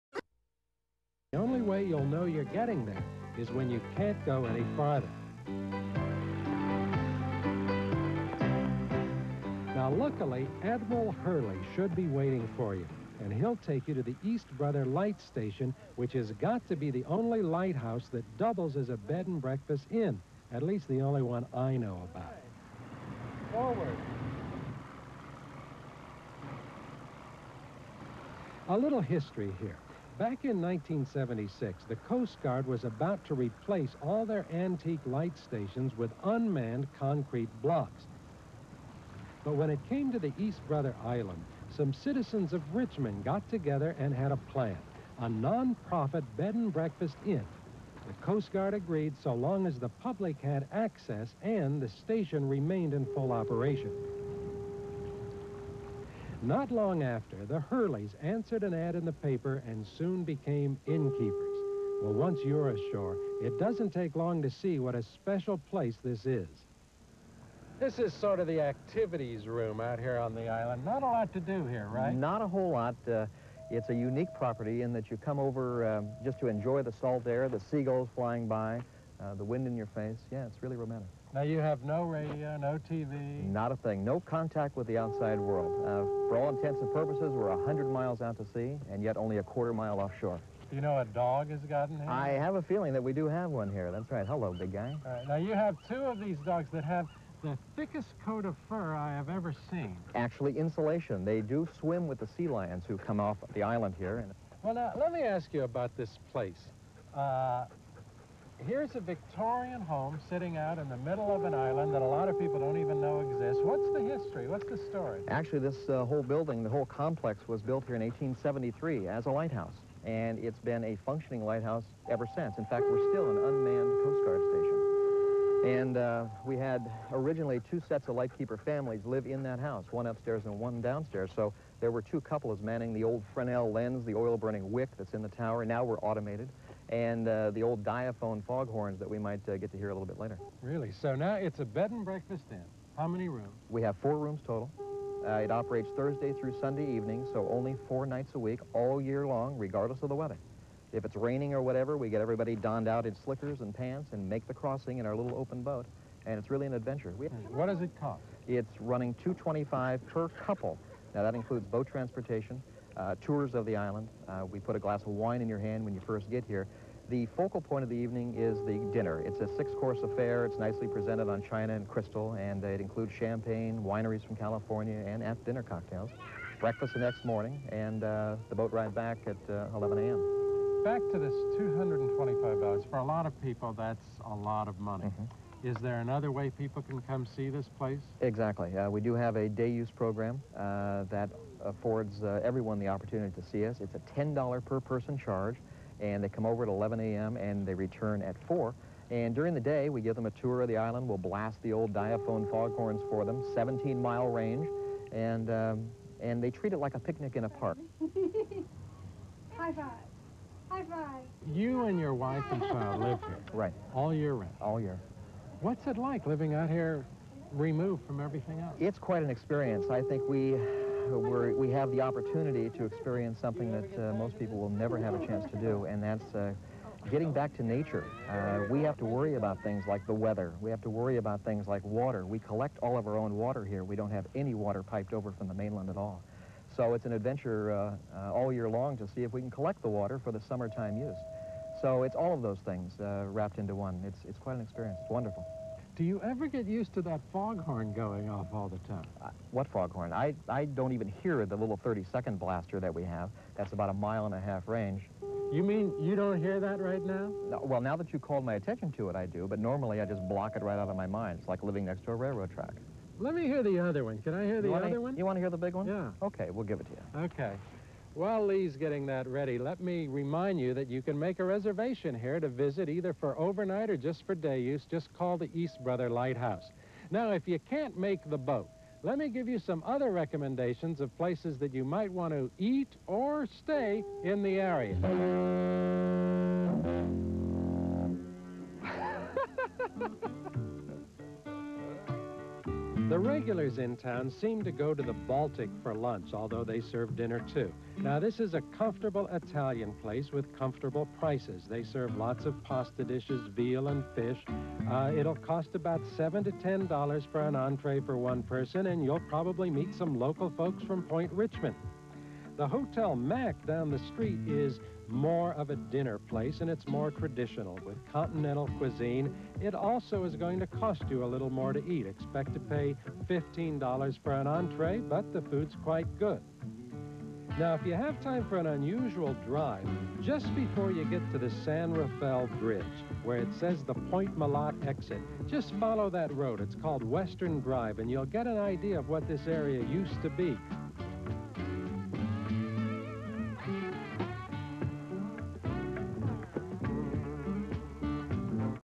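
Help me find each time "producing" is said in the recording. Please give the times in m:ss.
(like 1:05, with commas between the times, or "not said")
not said.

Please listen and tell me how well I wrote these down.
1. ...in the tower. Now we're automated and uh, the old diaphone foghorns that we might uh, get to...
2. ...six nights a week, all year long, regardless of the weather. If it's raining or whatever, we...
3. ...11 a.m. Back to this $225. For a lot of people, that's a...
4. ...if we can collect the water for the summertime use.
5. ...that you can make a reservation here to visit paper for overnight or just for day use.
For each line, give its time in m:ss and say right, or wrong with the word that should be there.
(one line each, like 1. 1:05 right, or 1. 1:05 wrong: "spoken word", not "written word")
1. 2:15 right
2. 2:27 wrong: "four", not "six"
3. 2:59 right
4. 3:59 right
5. 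4:30 wrong: "either", not "paper".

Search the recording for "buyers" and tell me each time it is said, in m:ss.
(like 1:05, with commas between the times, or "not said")
not said.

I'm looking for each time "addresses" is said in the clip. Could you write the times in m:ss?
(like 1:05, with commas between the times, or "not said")
not said.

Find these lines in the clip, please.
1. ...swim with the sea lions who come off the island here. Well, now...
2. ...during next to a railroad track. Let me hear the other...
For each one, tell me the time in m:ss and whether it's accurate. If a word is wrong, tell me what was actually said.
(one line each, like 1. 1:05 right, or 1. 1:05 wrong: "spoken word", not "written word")
1. 1:41 right
2. 4:21 wrong: "living", not "during".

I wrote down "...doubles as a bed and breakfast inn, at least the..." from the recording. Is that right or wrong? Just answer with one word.
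right.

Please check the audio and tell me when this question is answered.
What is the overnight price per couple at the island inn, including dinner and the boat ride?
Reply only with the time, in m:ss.
2:39.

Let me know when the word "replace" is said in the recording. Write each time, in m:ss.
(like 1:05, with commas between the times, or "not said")
0:33.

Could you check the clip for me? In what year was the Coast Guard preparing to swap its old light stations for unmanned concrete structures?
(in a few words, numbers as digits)
1976.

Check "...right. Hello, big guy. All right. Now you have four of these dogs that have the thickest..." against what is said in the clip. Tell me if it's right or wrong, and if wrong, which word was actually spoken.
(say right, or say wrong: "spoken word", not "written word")
wrong: "two", not "four".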